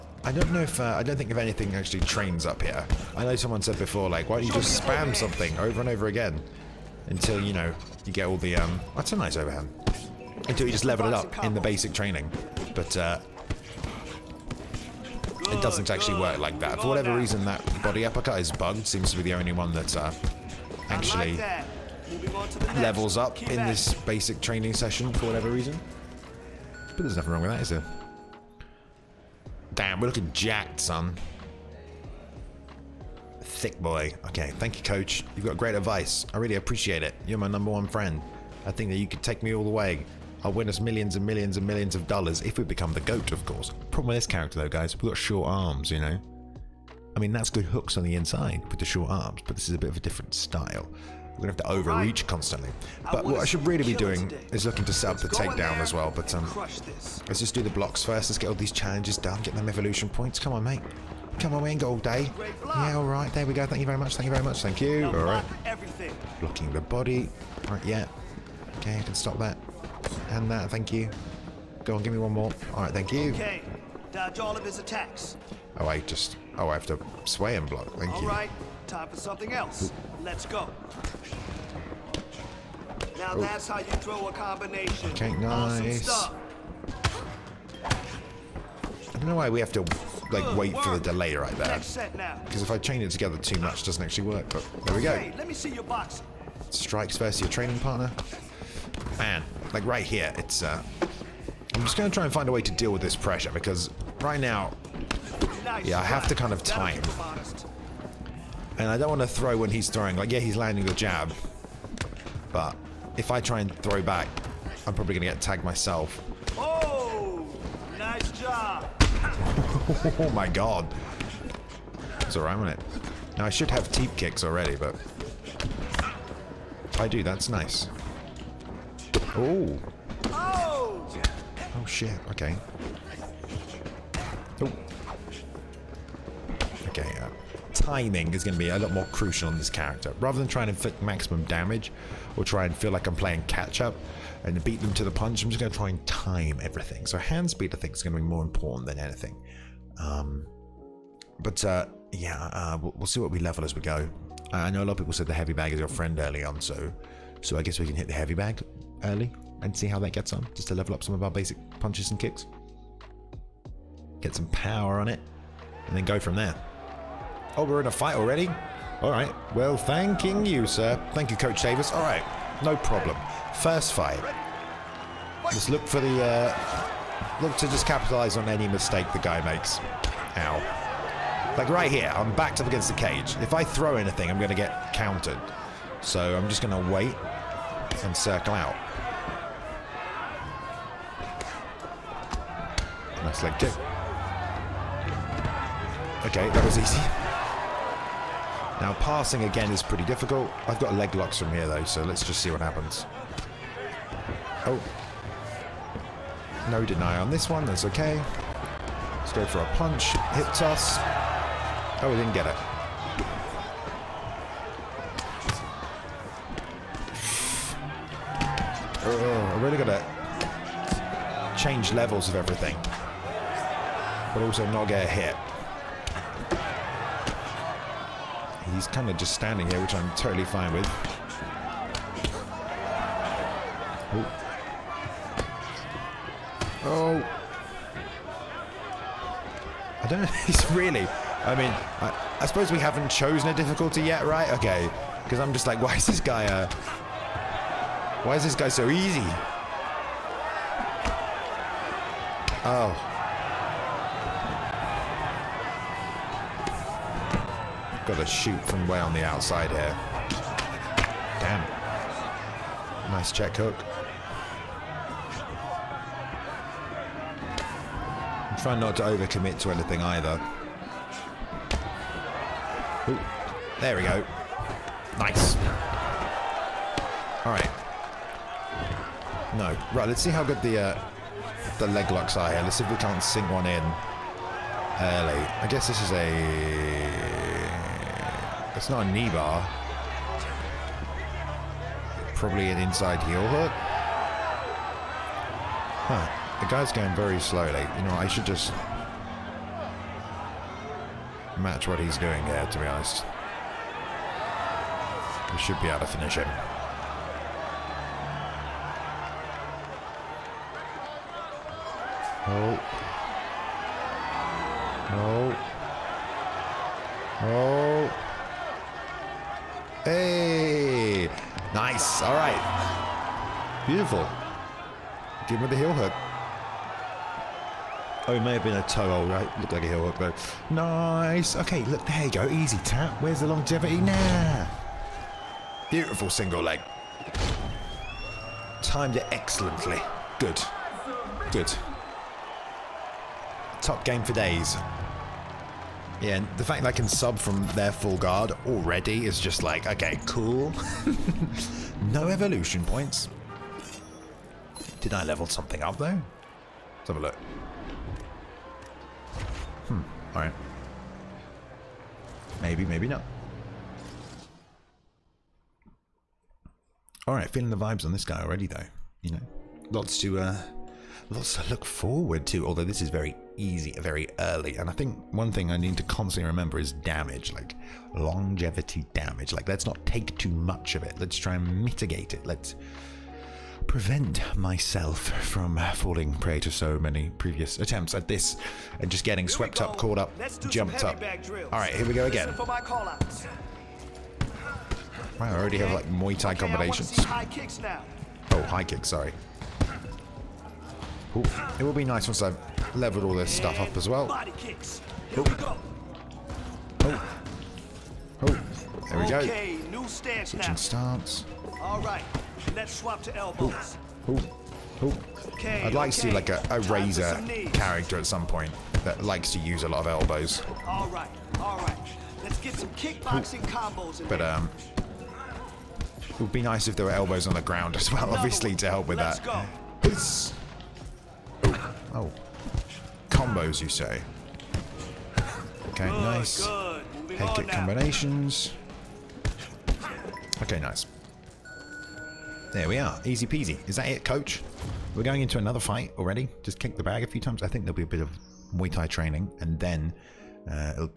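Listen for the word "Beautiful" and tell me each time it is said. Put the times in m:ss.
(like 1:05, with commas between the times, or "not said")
5:23, 5:35.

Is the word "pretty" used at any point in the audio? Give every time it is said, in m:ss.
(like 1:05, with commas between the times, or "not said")
3:19.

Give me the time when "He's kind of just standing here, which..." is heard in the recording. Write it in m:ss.
3:48.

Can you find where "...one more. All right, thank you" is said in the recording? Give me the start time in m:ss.
1:12.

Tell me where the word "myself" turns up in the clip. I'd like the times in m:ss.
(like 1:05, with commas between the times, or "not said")
1:55, 6:24.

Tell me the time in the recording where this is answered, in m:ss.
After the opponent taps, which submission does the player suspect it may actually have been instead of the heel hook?
5:28.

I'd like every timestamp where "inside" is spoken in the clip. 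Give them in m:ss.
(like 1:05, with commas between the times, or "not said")
0:48, 4:52.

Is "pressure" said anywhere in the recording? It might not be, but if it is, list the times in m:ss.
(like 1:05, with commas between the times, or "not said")
1:43.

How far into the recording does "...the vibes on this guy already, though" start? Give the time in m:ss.
6:07.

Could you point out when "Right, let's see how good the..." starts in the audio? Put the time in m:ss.
4:39.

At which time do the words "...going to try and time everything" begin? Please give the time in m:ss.
2:25.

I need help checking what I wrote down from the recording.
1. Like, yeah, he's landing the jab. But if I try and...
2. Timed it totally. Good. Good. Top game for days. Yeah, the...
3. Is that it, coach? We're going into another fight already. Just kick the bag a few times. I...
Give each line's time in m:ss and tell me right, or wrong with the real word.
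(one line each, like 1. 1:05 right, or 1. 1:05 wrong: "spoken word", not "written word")
1. 1:50 right
2. 5:38 wrong: "excellently", not "totally"
3. 7:23 right.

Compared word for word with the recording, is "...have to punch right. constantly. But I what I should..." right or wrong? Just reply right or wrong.
wrong.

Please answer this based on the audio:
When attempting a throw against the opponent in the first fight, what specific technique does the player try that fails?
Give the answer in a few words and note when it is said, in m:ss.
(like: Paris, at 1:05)
hip toss, at 3:30.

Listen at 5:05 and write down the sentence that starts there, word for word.
We should be able to finish him.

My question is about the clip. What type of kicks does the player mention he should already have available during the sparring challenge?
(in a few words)
teep kicks.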